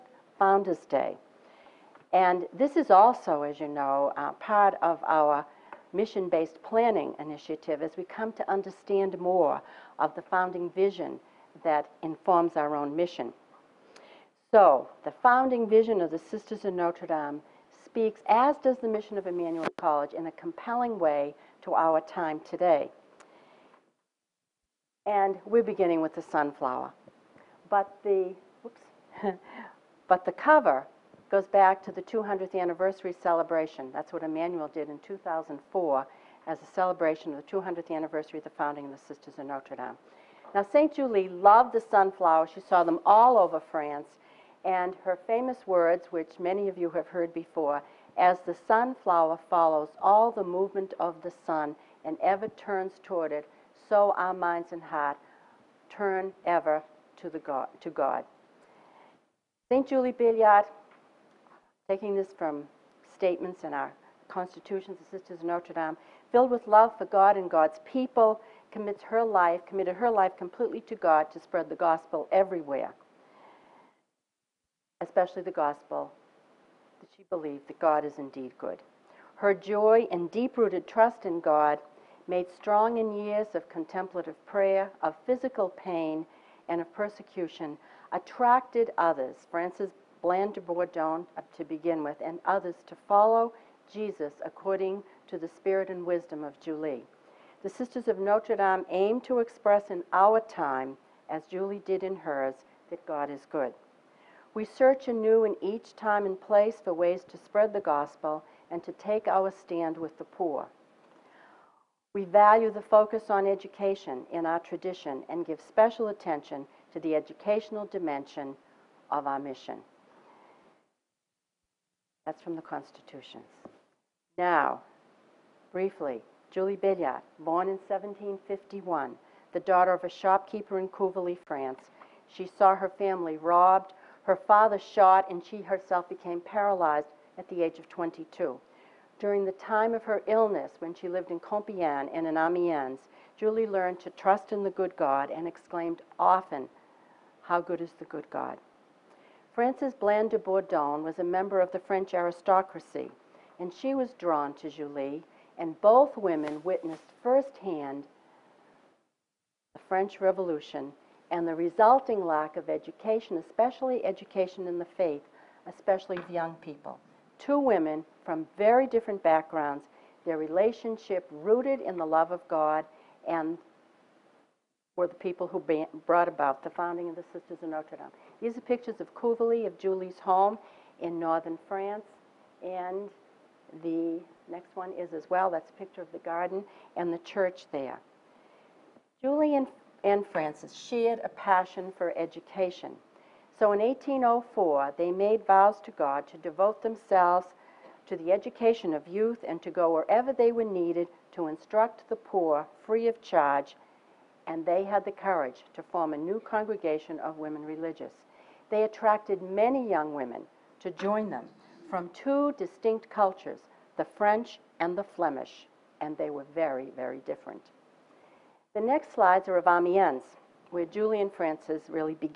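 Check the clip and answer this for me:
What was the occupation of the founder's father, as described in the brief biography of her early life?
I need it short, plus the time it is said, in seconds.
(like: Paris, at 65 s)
shopkeeper, at 130 s.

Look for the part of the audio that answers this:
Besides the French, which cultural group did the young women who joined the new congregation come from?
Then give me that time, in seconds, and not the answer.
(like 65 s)
215 s.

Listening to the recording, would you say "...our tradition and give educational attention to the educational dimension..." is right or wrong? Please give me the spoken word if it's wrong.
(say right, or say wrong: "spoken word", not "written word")
wrong: "special", not "educational".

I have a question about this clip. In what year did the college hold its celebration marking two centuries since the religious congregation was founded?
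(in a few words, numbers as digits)
2004.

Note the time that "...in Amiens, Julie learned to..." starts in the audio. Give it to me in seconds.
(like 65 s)
142 s.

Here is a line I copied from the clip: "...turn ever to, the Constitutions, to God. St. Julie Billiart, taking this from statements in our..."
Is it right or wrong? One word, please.
wrong.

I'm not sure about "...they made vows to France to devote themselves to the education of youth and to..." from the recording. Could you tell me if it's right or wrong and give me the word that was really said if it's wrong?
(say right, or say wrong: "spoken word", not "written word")
wrong: "God", not "France".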